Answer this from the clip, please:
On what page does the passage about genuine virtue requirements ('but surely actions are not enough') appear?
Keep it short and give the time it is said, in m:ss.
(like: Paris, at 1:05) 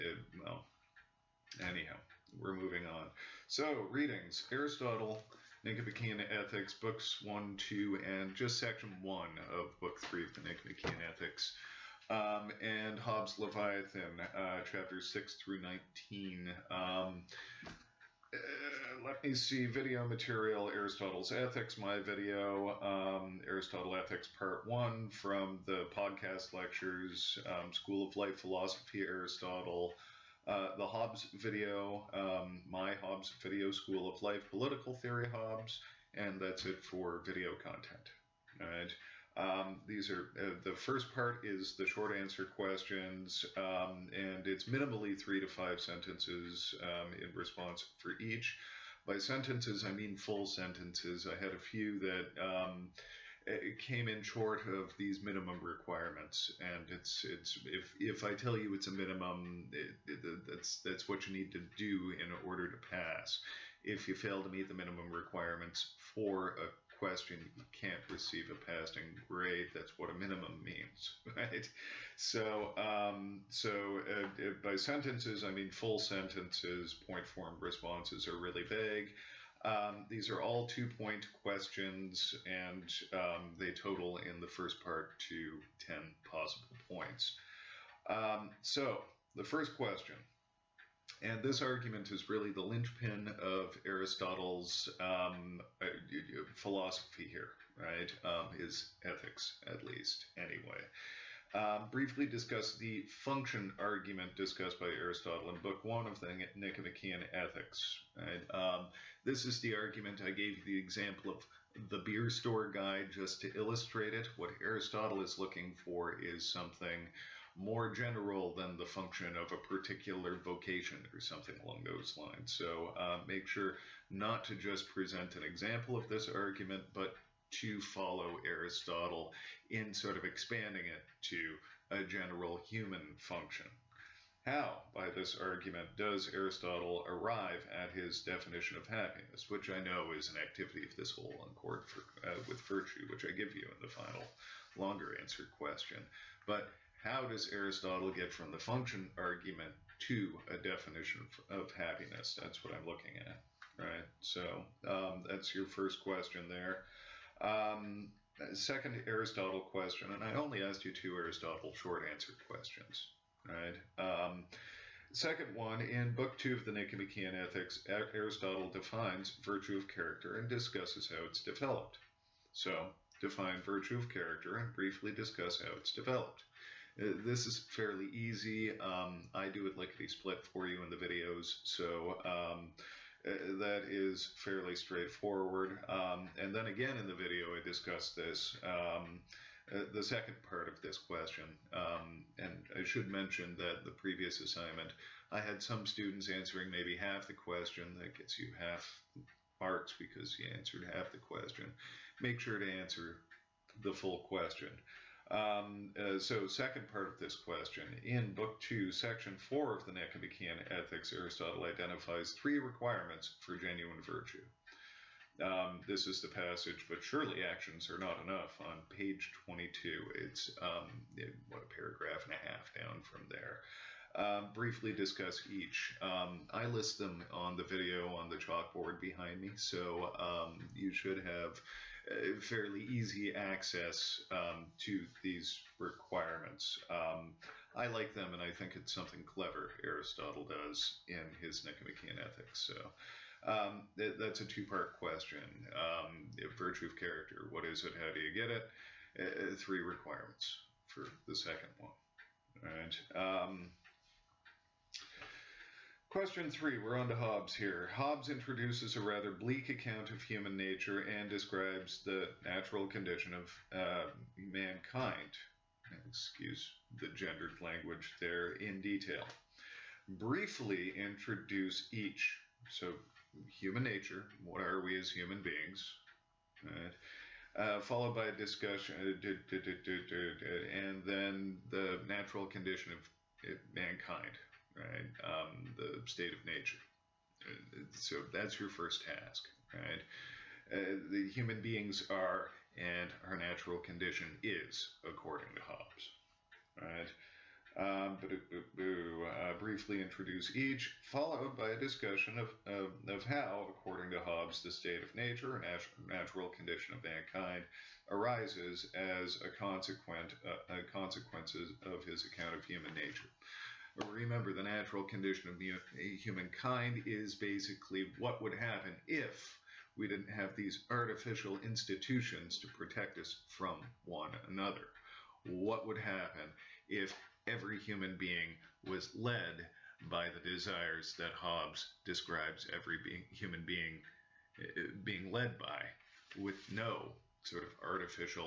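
22, at 3:38.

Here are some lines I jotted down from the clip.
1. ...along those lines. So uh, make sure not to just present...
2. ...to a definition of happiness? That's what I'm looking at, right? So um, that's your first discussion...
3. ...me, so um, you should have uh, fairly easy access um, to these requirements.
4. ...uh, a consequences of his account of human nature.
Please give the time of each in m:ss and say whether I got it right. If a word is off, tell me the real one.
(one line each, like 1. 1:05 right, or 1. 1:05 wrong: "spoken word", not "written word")
1. 2:01 right
2. 2:29 wrong: "question", not "discussion"
3. 3:49 right
4. 5:10 right.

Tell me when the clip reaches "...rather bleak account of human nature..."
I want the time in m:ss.
4:19.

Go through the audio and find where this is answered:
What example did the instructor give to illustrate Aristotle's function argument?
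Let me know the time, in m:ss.
1:51.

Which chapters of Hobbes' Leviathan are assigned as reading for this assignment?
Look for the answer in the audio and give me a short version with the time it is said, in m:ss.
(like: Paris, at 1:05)
6 through 19, at 0:14.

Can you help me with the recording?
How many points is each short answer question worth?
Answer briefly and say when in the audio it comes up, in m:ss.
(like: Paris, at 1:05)
2, at 1:20.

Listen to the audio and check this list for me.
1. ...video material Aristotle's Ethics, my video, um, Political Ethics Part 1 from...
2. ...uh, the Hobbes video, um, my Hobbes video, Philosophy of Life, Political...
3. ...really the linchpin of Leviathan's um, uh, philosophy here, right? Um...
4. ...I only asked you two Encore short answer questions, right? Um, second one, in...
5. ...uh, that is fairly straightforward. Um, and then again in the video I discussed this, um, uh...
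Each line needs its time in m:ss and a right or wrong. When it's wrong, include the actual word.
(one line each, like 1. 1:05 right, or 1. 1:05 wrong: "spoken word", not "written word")
1. 0:19 wrong: "Aristotle", not "Political"
2. 0:30 wrong: "School", not "Philosophy"
3. 1:32 wrong: "Aristotle", not "Leviathan"
4. 2:40 wrong: "Aristotle", not "Encore"
5. 3:03 right.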